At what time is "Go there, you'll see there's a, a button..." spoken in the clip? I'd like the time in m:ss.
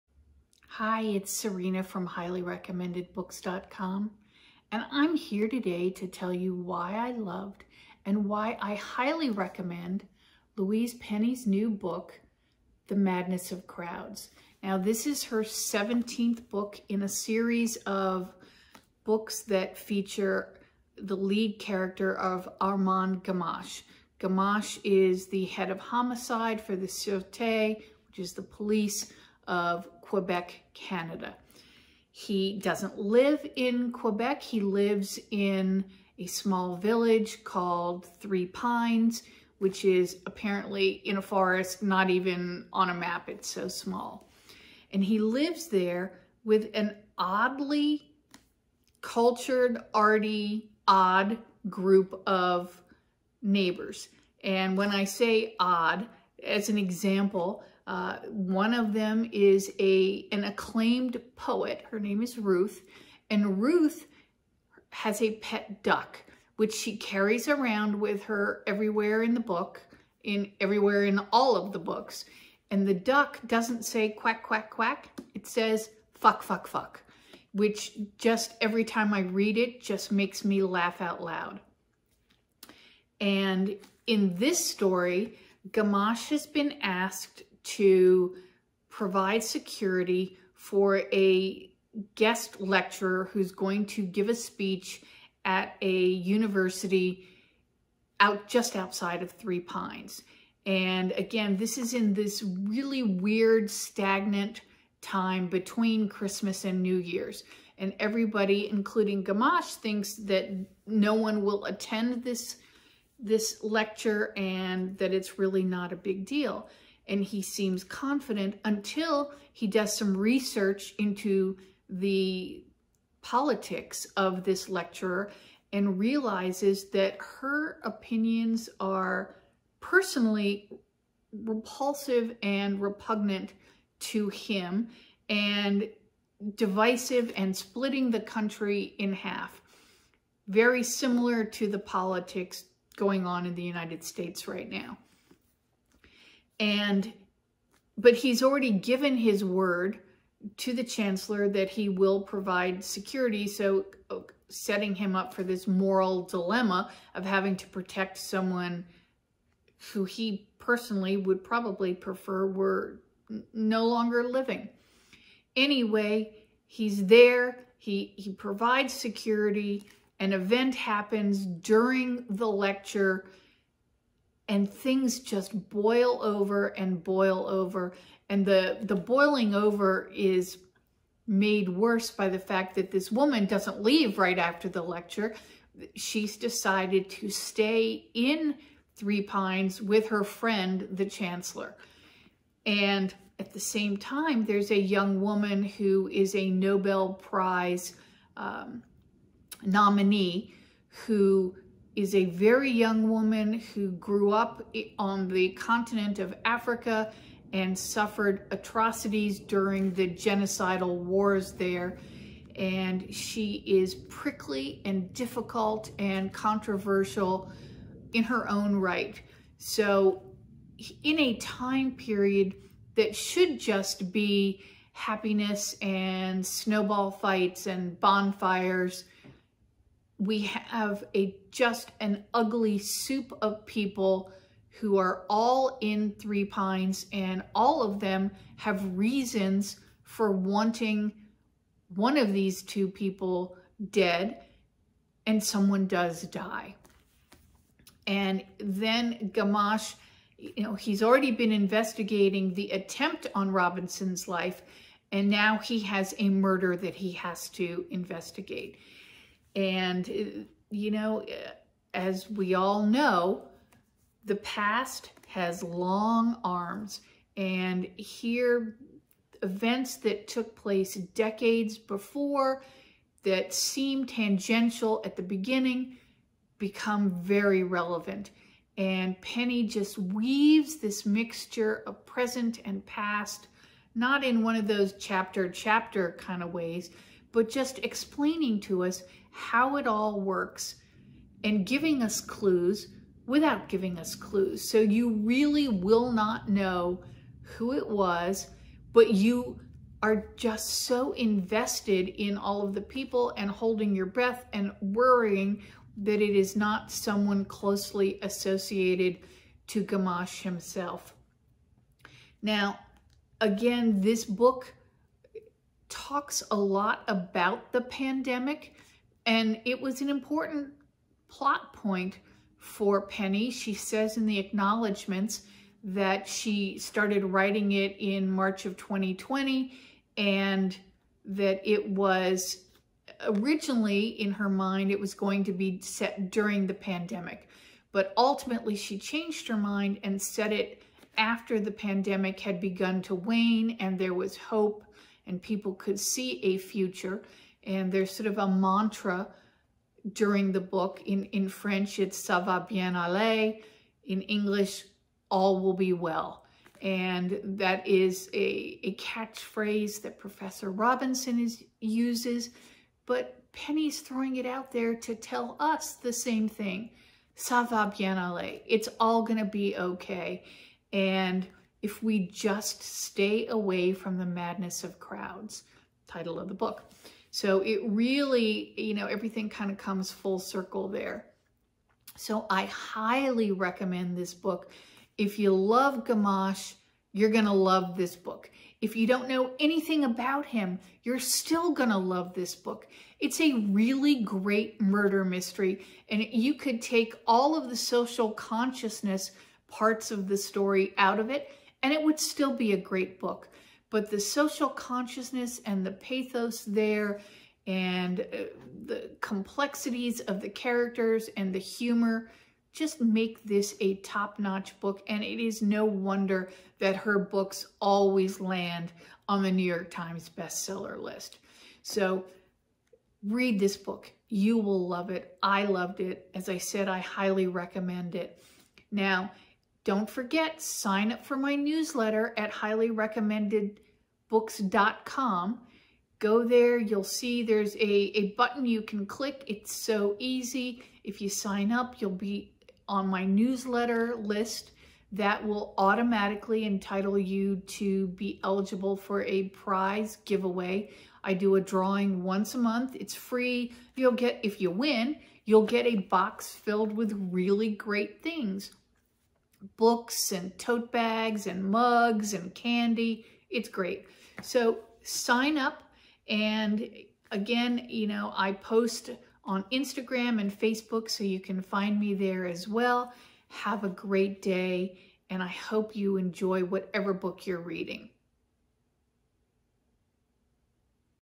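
7:16.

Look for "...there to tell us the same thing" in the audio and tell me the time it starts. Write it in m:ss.
6:04.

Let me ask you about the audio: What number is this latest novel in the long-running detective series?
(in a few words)
17th.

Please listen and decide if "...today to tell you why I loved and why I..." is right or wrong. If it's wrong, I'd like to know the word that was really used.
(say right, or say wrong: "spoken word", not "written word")
right.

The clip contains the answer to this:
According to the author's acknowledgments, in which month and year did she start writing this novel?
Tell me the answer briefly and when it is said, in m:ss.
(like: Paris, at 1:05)
March 2020, at 5:28.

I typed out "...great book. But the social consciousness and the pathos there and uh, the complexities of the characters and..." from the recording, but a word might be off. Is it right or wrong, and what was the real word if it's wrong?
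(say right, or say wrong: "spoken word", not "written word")
right.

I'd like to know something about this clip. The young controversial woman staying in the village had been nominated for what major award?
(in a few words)
Nobel Prize.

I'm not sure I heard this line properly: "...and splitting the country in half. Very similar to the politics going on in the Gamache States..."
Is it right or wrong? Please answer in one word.
wrong.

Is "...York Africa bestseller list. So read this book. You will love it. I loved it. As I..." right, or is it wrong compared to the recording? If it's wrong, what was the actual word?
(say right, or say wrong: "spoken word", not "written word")
wrong: "Times", not "Africa".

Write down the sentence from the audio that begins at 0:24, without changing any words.
Gamache is the head of homicide for the Sûreté, which is the police of Quebec, Canada.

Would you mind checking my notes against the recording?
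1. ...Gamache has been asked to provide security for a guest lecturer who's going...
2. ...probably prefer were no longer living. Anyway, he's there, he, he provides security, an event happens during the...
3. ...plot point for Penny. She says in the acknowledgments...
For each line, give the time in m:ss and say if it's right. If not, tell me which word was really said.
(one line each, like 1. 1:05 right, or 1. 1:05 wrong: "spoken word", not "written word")
1. 1:25 right
2. 2:41 right
3. 5:21 right.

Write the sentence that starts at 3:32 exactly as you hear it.
And she is prickly and difficult and controversial in her own right.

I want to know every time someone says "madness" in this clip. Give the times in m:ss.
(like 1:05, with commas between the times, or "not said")
0:12, 6:14.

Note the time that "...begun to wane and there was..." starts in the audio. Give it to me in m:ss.
5:42.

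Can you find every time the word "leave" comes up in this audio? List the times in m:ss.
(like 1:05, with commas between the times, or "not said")
3:03.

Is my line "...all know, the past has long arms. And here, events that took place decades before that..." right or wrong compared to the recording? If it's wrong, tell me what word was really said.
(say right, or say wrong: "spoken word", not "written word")
right.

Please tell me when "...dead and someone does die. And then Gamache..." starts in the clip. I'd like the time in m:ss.
4:03.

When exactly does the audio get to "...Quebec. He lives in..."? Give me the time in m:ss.
0:33.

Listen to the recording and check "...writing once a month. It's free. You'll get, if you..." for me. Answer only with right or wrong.
wrong.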